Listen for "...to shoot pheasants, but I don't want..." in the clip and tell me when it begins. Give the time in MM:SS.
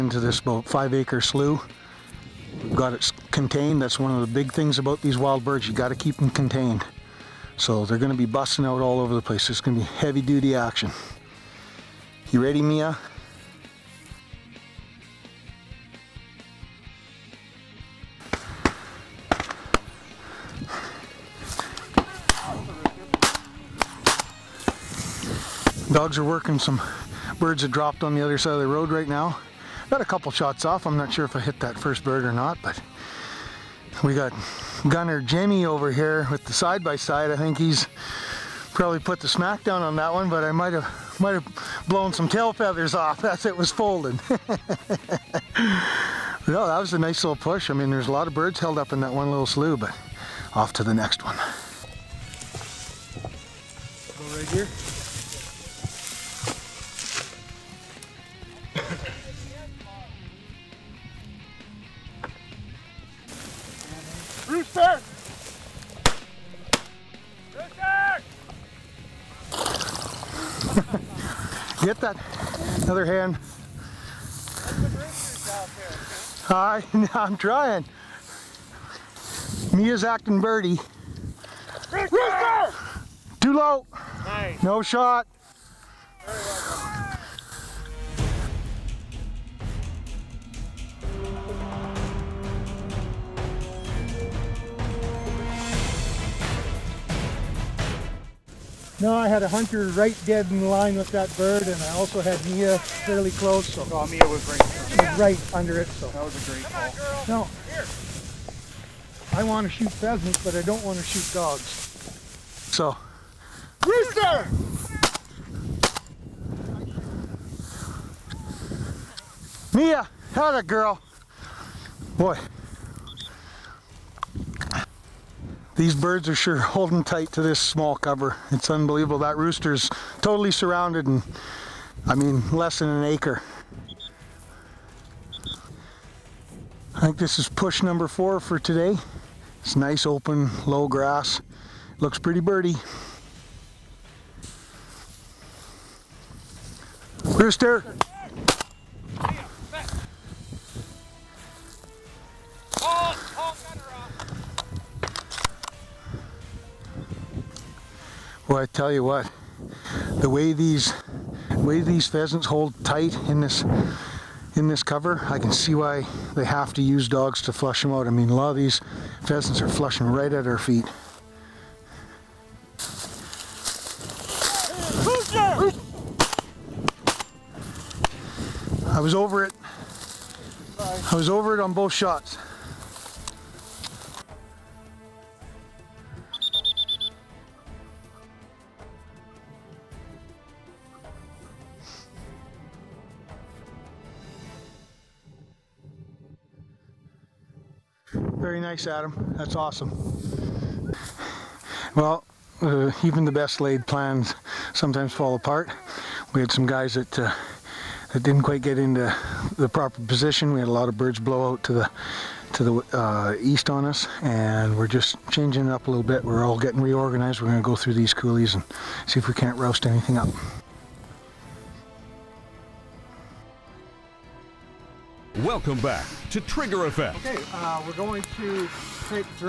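01:49.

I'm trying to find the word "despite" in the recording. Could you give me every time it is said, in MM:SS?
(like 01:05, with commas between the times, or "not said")
not said.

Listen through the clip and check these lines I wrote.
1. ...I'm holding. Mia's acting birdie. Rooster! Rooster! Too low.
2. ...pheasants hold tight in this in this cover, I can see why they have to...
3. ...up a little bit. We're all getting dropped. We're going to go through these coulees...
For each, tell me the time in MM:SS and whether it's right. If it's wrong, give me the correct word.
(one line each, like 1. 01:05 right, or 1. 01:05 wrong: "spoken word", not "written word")
1. 01:17 wrong: "trying", not "holding"
2. 02:42 right
3. 03:35 wrong: "reorganized", not "dropped".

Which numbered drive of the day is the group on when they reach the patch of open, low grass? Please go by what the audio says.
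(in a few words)
4.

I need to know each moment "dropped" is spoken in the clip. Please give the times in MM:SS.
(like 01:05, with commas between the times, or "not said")
00:27.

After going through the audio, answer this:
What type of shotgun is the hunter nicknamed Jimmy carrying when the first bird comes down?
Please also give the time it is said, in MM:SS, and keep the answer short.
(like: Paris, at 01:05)
Side-by-side, at 00:36.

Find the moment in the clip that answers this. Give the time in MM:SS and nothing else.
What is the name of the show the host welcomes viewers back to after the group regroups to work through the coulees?
03:46.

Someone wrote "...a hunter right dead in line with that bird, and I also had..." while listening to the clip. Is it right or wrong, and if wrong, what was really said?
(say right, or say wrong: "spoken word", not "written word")
right.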